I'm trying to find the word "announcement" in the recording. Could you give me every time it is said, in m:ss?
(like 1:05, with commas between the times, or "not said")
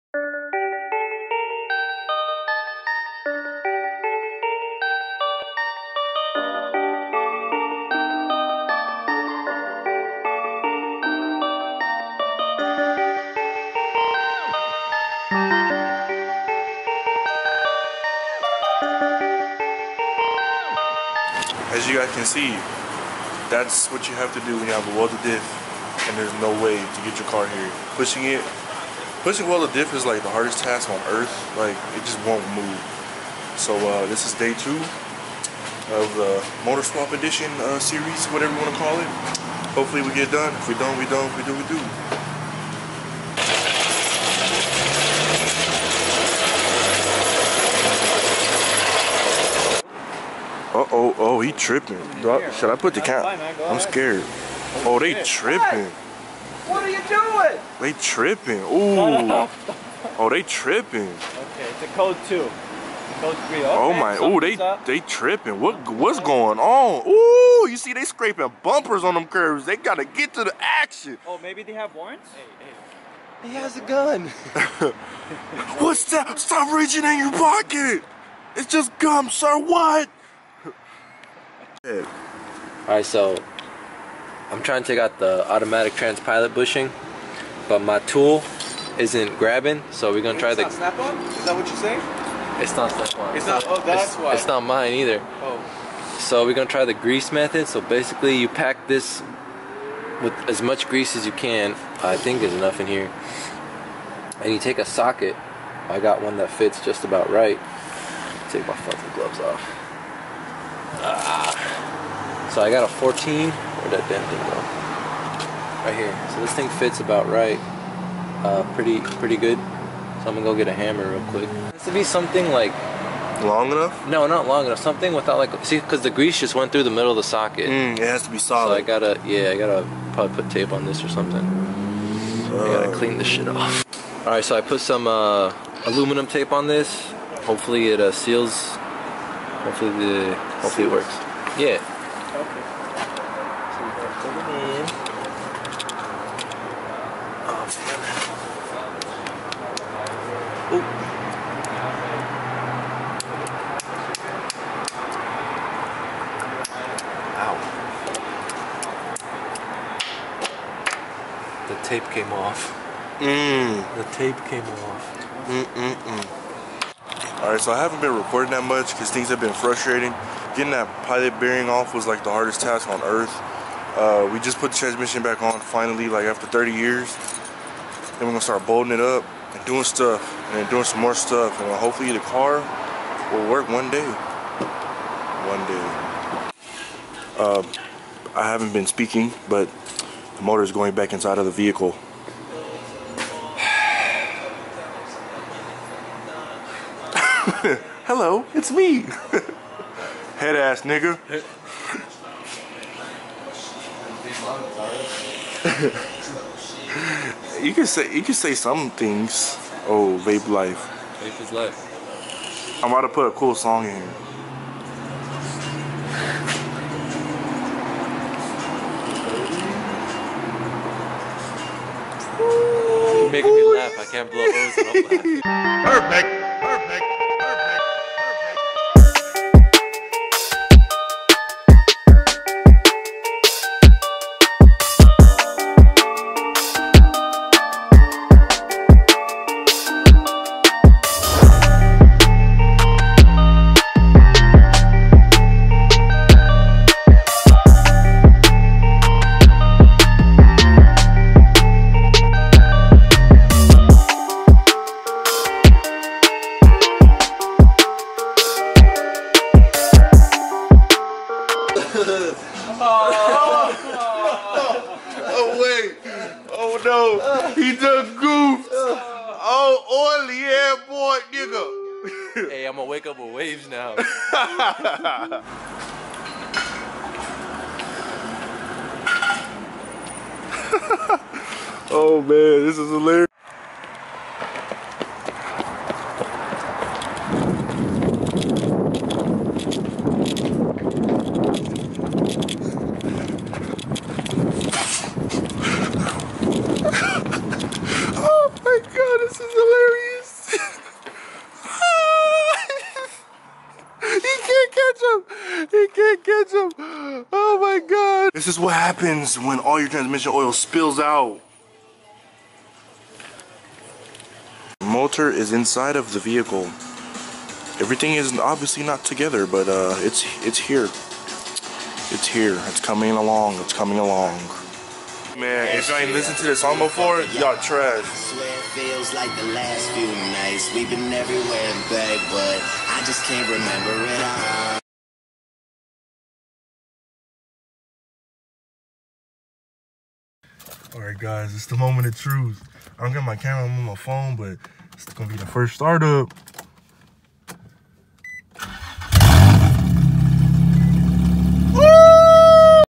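not said.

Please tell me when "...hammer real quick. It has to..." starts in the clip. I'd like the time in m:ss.
2:00.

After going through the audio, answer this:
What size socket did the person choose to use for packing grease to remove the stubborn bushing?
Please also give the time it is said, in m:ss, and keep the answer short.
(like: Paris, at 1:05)
14, at 1:52.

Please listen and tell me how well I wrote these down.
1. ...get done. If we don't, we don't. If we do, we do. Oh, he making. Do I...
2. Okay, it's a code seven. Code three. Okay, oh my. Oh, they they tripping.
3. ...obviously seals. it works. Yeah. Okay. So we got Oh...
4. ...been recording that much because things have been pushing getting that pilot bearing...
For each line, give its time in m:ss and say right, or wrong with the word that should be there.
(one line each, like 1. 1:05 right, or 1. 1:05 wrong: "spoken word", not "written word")
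1. 0:40 wrong: "tripping", not "making"
2. 1:01 wrong: "two", not "seven"
3. 2:20 wrong: "hopefully", not "obviously"
4. 2:47 wrong: "frustrating", not "pushing".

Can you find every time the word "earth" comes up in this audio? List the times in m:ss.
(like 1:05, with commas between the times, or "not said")
0:31, 2:53.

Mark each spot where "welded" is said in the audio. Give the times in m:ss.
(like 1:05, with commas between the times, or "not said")
0:24, 0:29.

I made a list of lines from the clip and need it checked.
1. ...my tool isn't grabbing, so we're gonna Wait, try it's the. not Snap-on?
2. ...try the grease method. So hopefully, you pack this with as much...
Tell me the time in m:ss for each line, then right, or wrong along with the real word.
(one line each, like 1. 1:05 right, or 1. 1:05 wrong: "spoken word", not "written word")
1. 1:27 right
2. 1:36 wrong: "basically", not "hopefully".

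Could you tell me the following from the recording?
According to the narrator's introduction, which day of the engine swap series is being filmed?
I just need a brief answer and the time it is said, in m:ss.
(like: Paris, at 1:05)
Day 2, at 0:34.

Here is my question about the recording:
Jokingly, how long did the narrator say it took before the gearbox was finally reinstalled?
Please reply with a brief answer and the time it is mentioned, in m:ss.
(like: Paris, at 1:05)
30 years, at 2:56.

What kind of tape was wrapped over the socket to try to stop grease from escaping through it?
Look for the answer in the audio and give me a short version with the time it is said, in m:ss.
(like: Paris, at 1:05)
Aluminum tape, at 2:15.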